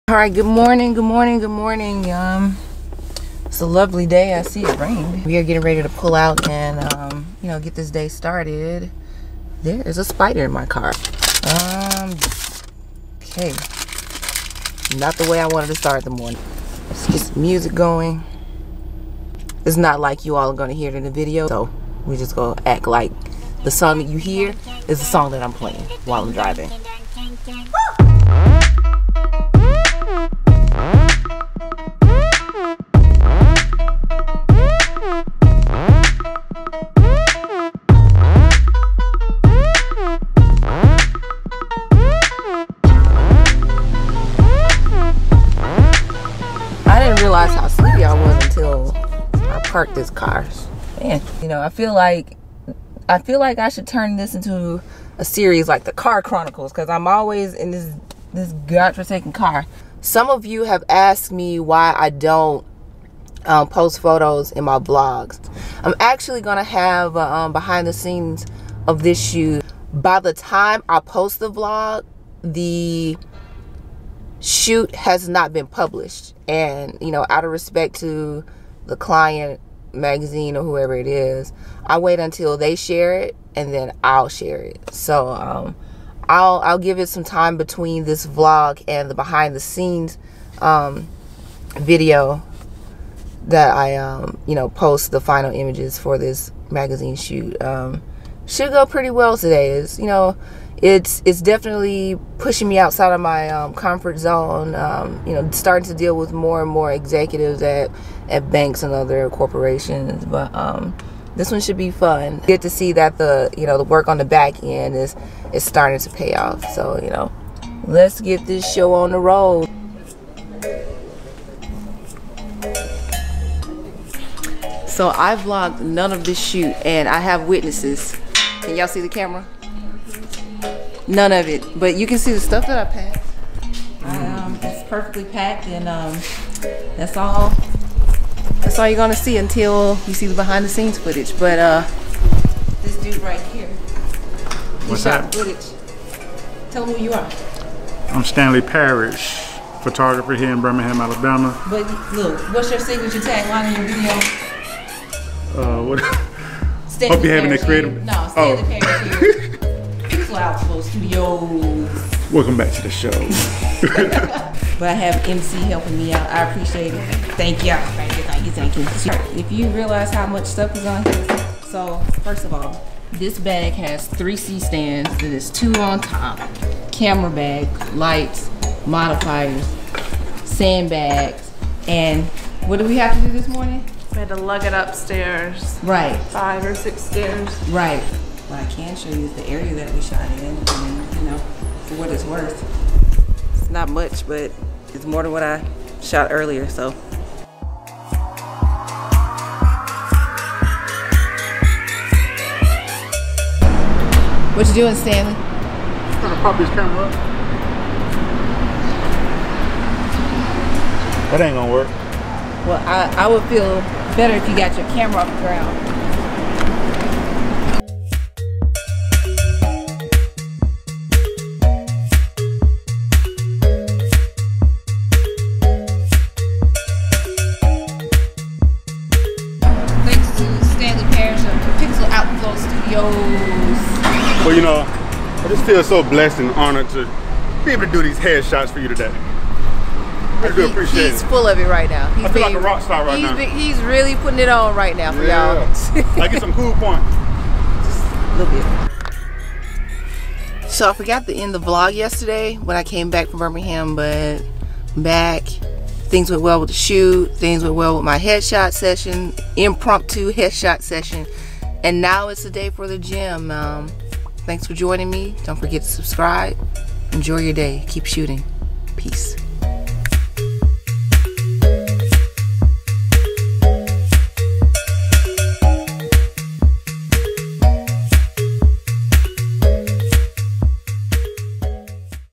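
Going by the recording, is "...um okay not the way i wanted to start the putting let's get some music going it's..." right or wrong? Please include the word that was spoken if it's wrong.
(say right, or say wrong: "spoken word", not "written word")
wrong: "morning", not "putting".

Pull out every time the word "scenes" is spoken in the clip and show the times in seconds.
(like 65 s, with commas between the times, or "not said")
67 s, 89 s, 140 s.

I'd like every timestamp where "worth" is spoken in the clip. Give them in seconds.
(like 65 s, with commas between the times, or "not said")
192 s.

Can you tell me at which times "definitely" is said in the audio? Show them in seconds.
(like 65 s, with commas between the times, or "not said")
101 s.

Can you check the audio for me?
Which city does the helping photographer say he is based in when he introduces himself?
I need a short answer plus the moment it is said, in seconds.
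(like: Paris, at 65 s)
Birmingham, Alabama, at 150 s.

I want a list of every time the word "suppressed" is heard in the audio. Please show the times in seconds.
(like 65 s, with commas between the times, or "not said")
not said.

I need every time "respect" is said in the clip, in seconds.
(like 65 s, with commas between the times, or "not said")
77 s.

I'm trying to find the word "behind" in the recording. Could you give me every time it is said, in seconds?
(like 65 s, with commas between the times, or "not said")
67 s, 89 s, 140 s.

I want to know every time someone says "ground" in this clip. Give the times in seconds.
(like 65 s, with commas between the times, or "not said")
215 s.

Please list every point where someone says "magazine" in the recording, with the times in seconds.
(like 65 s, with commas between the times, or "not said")
79 s, 96 s.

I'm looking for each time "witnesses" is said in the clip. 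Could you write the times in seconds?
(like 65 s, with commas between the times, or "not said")
127 s.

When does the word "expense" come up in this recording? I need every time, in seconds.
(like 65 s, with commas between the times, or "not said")
not said.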